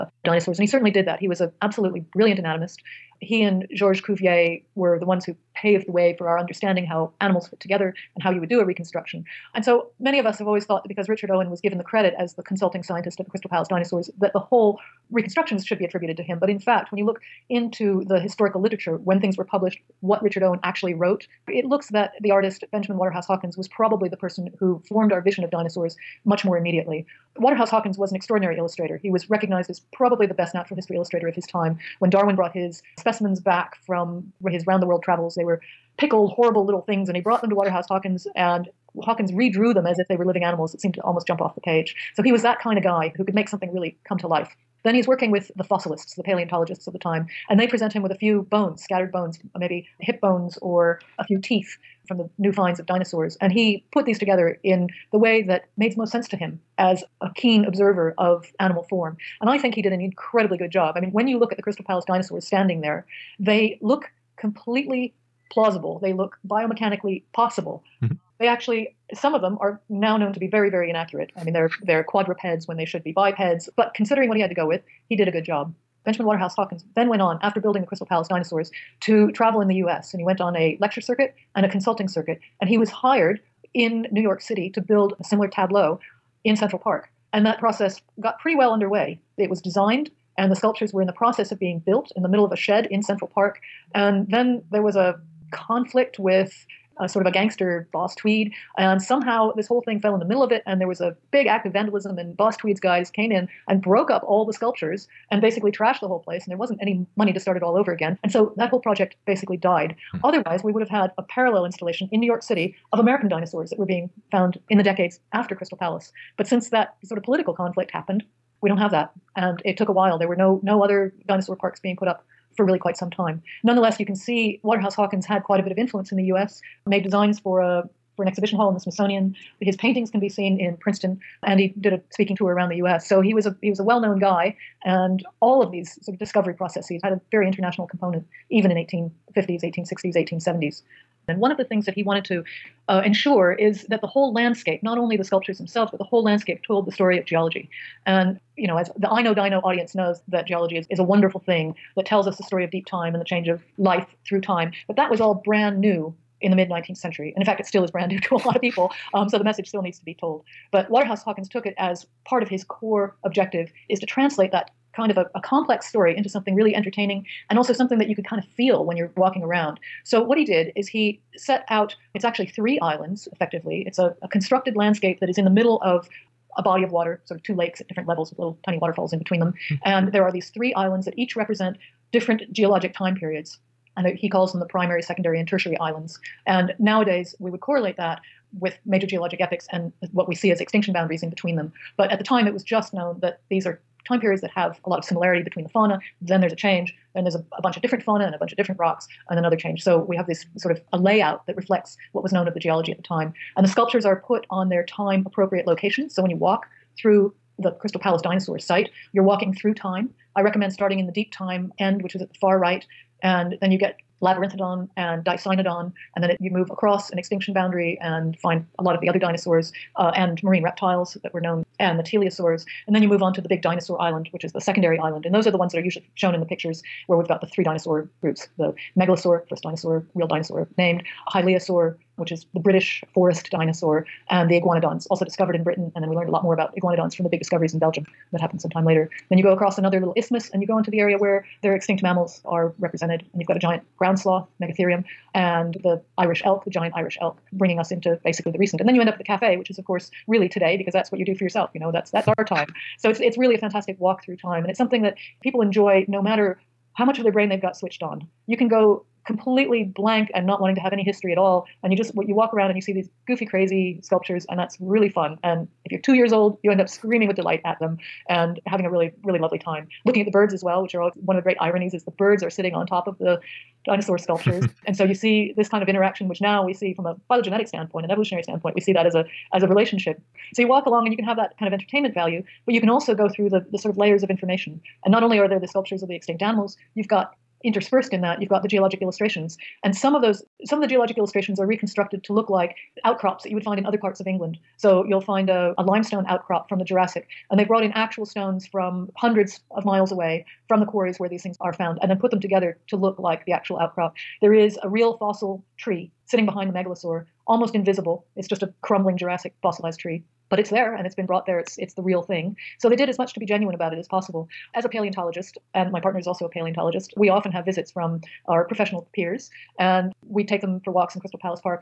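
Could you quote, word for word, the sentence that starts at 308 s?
It's just a crumbling Jurassic fossilized tree.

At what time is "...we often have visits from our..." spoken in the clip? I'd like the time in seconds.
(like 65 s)
317 s.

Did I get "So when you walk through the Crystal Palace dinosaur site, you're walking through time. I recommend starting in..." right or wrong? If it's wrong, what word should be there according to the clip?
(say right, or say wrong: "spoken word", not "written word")
right.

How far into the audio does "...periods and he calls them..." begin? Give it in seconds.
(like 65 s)
183 s.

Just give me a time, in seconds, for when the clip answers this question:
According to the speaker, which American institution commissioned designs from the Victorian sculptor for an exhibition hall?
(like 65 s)
128 s.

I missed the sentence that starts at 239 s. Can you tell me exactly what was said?
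Then you go across another little isthmus and you go into the area where their extinct mammals are represented.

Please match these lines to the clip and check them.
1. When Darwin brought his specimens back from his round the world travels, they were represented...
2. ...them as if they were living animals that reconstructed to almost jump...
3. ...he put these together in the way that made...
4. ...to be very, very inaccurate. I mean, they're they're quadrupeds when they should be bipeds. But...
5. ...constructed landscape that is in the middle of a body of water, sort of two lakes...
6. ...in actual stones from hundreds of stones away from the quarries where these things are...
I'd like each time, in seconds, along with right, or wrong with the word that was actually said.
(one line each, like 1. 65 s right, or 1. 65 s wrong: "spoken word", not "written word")
1. 31 s wrong: "pickled", not "represented"
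2. 39 s wrong: "seemed", not "reconstructed"
3. 53 s right
4. 70 s right
5. 174 s right
6. 297 s wrong: "miles", not "stones".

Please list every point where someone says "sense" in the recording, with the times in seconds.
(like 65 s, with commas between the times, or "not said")
56 s.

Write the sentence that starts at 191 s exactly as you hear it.
But at the time, it was just known that these are time periods that have a lot of similarity between the fauna.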